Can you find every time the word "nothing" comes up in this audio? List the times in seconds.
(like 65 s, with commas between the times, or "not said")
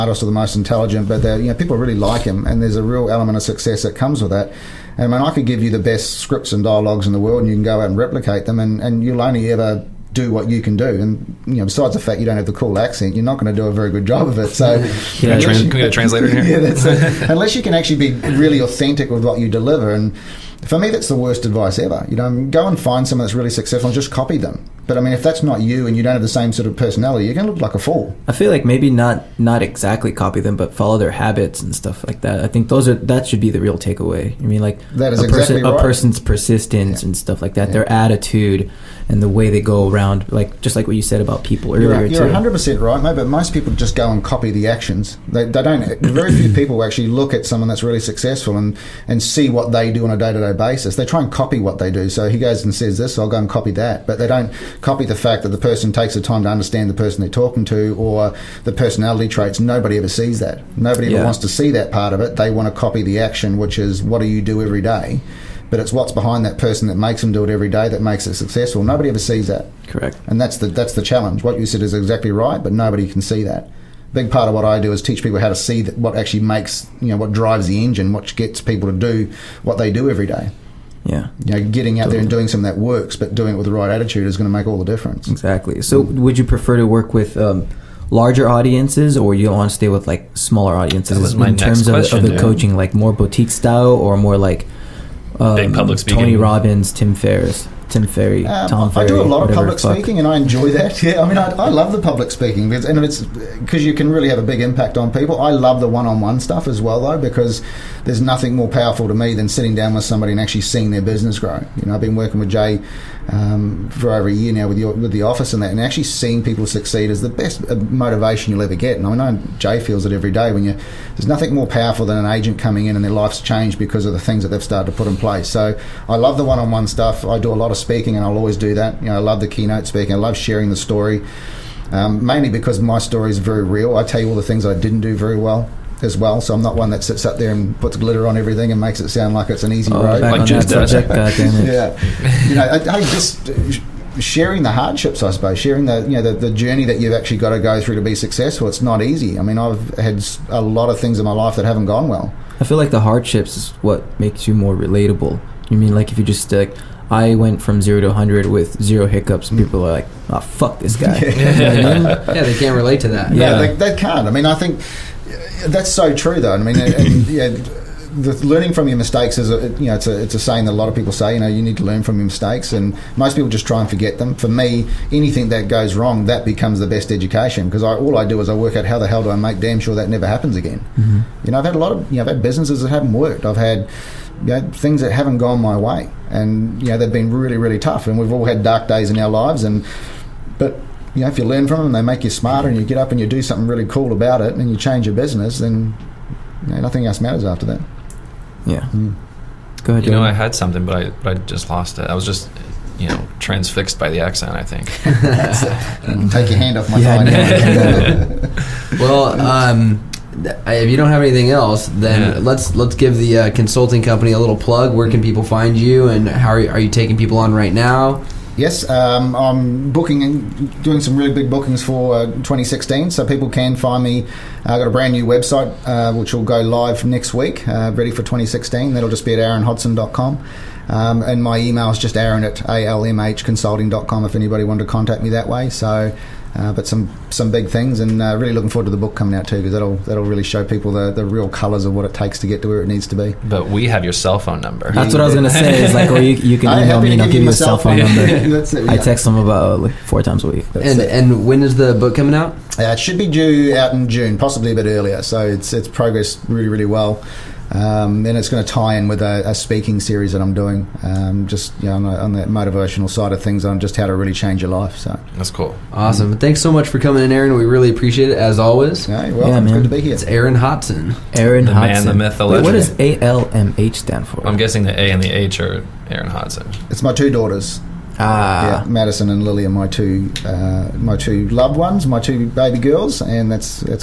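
108 s, 121 s, 196 s.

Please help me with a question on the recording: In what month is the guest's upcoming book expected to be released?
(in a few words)
June.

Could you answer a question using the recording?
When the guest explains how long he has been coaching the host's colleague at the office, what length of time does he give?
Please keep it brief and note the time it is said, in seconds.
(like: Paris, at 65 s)
Over a year, at 114 s.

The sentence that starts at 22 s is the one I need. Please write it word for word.
You know, go and find someone that's really successful and just copy them.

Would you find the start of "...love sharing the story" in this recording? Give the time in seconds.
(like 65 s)
130 s.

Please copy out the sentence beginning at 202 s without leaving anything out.
I was just, you know, transfixed by the accent, I think.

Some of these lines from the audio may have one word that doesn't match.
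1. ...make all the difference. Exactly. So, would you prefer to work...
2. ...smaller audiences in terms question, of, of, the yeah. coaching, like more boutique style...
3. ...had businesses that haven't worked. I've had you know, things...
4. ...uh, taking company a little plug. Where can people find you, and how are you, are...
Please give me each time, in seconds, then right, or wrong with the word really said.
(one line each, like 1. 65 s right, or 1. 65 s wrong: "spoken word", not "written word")
1. 84 s right
2. 90 s right
3. 182 s right
4. 213 s wrong: "consulting", not "taking".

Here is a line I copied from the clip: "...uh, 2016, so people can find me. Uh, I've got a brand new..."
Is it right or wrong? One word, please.
right.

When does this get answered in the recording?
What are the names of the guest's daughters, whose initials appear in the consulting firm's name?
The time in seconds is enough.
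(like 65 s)
278 s.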